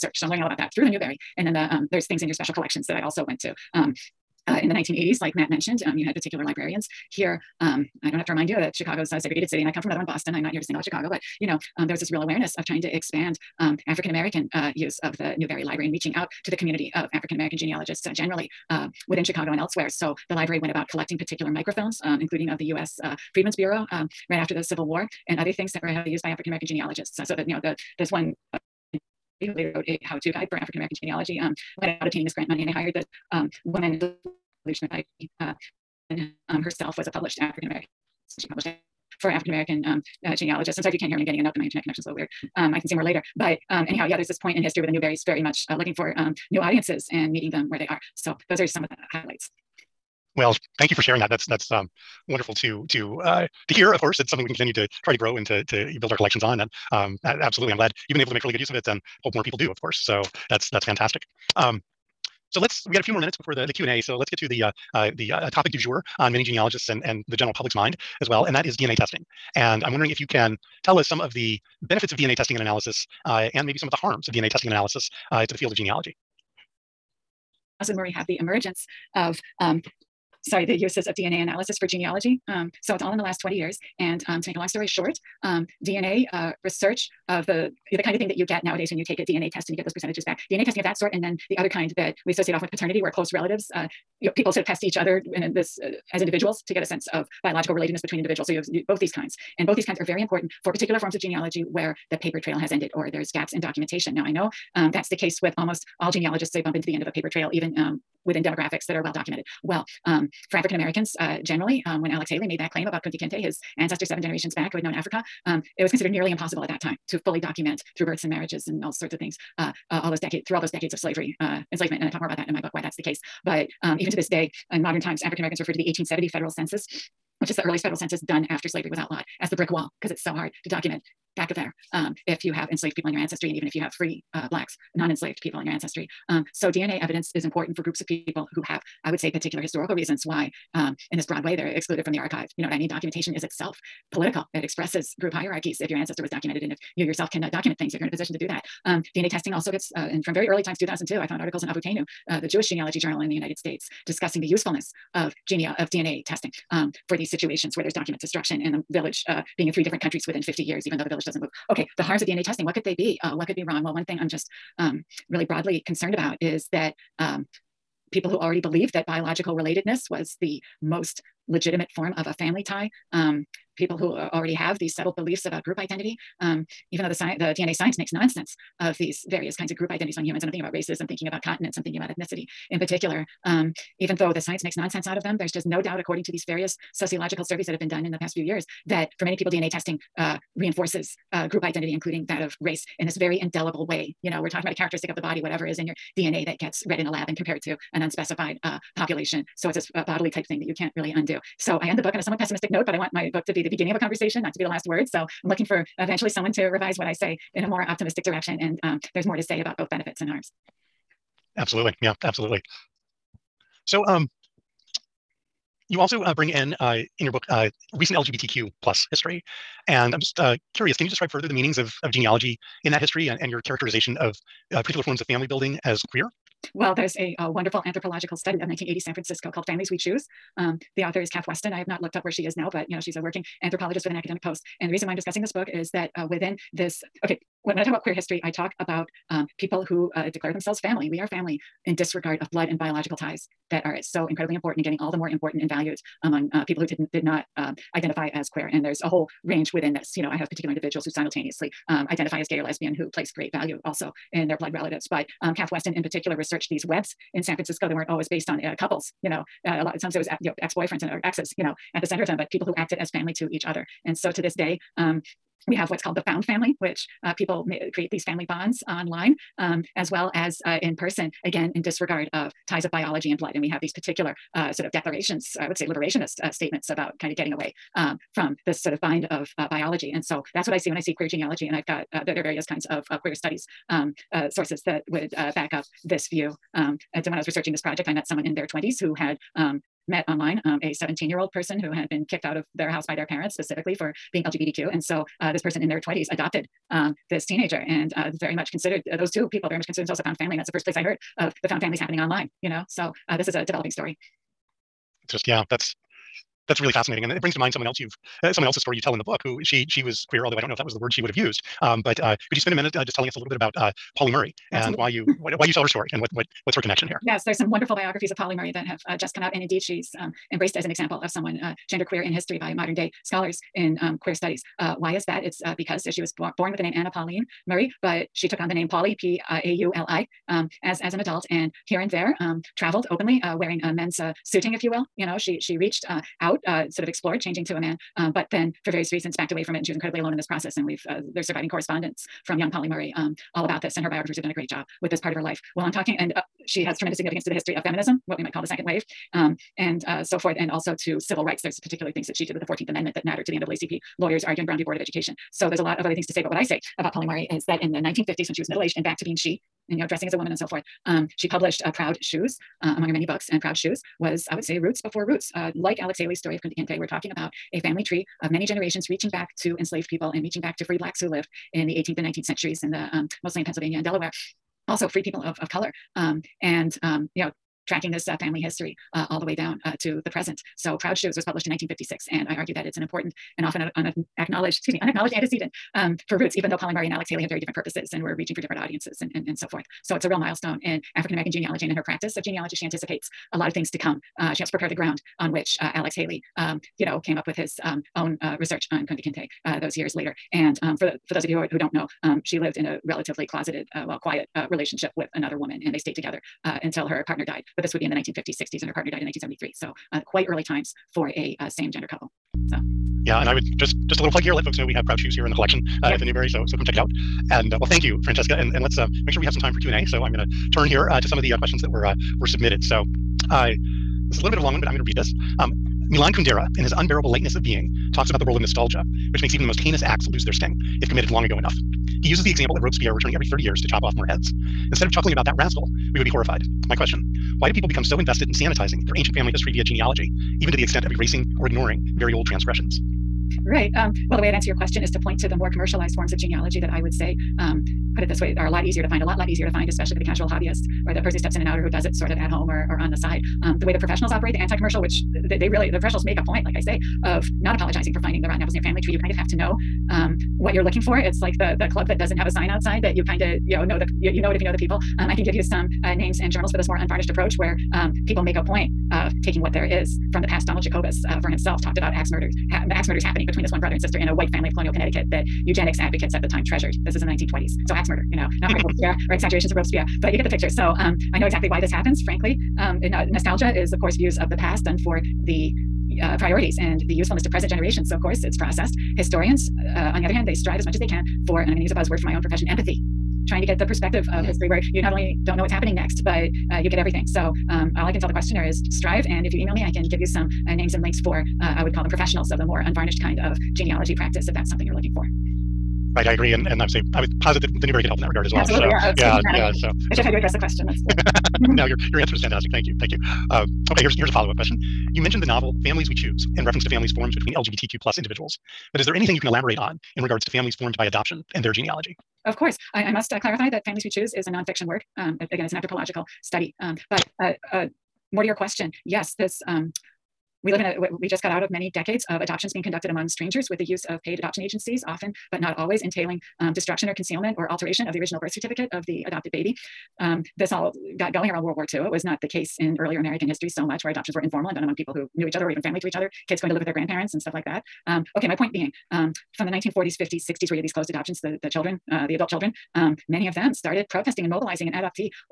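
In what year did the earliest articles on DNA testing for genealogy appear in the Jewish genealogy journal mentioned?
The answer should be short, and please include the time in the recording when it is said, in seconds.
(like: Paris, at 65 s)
2002, at 150 s.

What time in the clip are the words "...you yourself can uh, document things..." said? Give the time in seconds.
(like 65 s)
146 s.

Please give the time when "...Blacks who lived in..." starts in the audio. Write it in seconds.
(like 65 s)
370 s.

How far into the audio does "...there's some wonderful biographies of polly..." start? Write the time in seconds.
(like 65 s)
317 s.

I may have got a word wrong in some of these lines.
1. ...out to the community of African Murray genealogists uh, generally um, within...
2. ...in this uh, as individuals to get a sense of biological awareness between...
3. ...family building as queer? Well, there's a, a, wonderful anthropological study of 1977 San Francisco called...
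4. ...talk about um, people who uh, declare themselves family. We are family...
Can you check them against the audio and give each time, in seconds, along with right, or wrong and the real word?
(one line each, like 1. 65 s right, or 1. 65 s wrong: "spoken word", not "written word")
1. 16 s wrong: "American", not "Murray"
2. 95 s wrong: "relatedness", not "awareness"
3. 225 s wrong: "1980", not "1977"
4. 238 s right.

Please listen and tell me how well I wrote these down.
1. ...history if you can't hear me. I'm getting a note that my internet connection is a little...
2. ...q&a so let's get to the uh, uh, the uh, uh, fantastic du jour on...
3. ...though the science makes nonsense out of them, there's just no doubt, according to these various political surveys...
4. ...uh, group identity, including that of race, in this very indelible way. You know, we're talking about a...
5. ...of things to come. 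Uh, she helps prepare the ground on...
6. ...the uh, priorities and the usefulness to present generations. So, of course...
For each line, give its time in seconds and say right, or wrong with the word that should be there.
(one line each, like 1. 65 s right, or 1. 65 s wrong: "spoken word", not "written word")
1. 40 s wrong: "sorry", not "history"
2. 63 s wrong: "topic", not "fantastic"
3. 184 s wrong: "sociological", not "political"
4. 191 s right
5. 393 s right
6. 485 s right.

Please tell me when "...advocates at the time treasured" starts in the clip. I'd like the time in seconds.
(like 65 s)
475 s.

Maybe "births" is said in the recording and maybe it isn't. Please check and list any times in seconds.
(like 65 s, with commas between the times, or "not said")
118 s, 538 s.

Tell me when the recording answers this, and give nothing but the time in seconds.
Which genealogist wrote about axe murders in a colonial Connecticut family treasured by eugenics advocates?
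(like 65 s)
470 s.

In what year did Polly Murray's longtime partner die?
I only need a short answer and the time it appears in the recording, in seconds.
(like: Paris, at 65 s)
1973, at 409 s.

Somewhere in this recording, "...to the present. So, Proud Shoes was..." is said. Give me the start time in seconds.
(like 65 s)
379 s.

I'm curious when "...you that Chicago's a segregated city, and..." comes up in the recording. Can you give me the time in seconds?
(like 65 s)
8 s.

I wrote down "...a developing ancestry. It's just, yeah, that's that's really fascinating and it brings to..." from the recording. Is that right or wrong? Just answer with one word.
wrong.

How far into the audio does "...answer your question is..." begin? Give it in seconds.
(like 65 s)
444 s.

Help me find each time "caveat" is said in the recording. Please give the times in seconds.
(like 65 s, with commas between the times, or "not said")
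not said.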